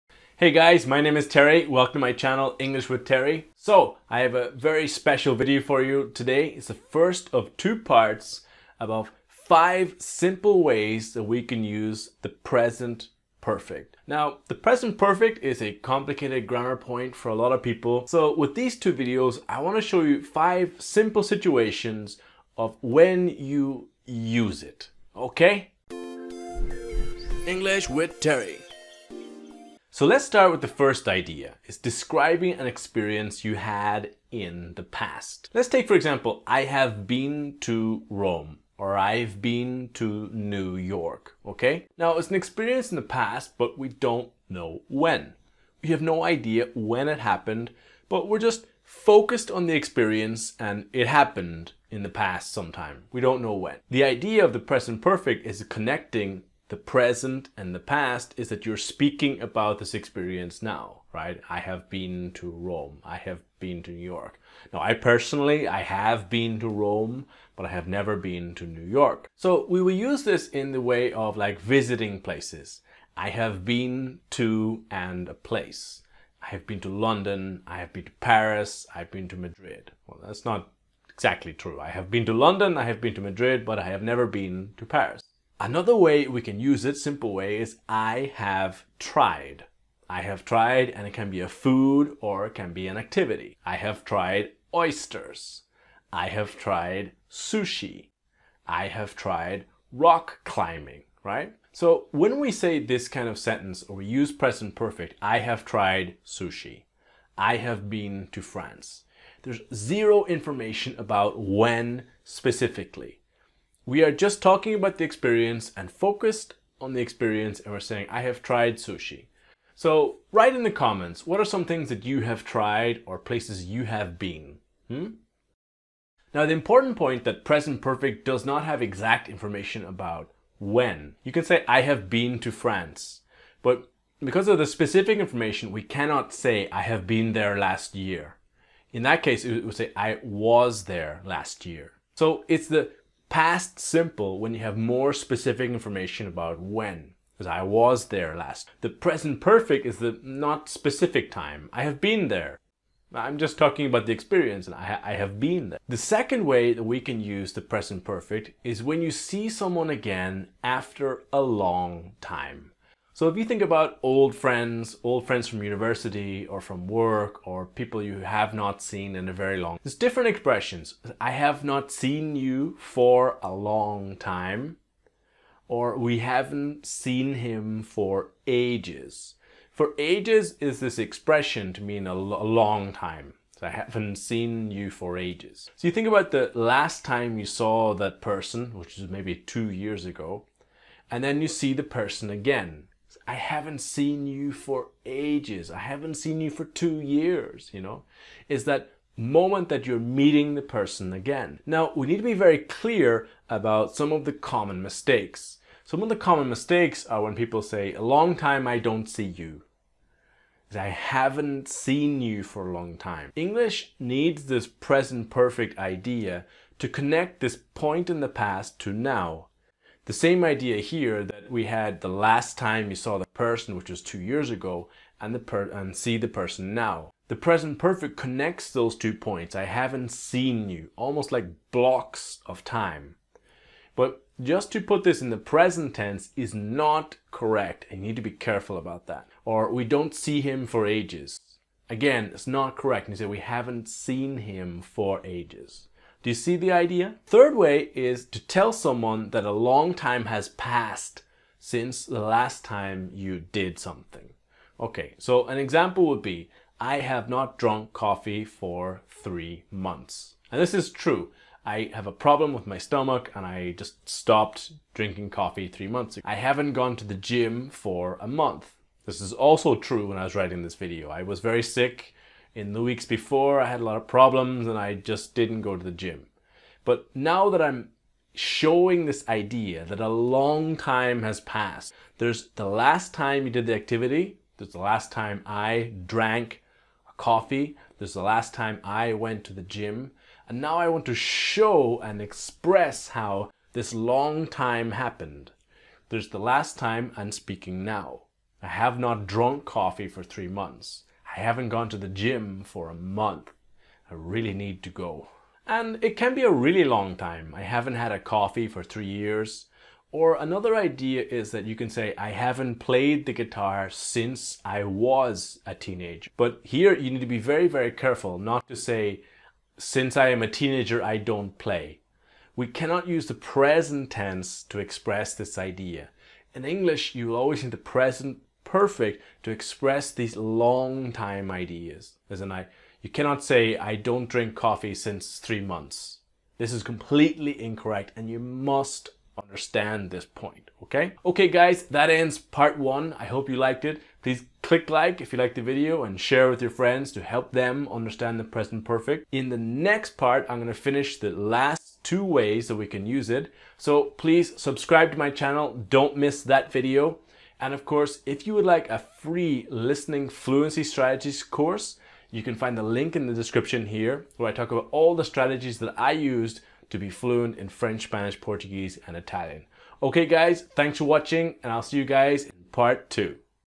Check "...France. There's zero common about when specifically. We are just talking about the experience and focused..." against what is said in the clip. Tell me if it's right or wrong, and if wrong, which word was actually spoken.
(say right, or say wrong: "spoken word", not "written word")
wrong: "information", not "common".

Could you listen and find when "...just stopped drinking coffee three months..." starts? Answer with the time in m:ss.
4:23.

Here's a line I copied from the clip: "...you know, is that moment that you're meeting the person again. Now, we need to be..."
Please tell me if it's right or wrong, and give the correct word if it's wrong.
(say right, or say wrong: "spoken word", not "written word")
right.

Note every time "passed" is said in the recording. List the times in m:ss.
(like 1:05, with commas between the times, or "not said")
4:10, 4:41.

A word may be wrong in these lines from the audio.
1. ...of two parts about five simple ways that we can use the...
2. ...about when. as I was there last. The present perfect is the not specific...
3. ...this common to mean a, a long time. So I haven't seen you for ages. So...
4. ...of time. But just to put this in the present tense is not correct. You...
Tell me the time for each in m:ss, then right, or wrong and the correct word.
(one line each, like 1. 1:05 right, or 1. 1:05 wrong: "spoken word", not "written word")
1. 0:07 right
2. 2:26 right
3. 3:00 wrong: "expression", not "common"
4. 3:52 right.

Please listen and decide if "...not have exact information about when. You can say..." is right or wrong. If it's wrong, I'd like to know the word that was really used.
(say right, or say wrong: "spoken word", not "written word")
right.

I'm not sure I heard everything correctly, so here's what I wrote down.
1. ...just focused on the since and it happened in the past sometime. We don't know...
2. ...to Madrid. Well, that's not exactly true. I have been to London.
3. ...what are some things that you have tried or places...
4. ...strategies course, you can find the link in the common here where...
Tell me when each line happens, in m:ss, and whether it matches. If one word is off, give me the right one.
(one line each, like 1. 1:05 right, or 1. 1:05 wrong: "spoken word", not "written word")
1. 0:48 wrong: "experience", not "since"
2. 1:19 right
3. 2:01 right
4. 6:00 wrong: "description", not "common".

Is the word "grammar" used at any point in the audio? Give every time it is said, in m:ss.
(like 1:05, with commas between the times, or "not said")
0:16.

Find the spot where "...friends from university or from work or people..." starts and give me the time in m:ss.
2:45.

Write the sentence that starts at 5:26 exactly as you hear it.
In English, you always need the present perfect to express these long time ideas, isn't it?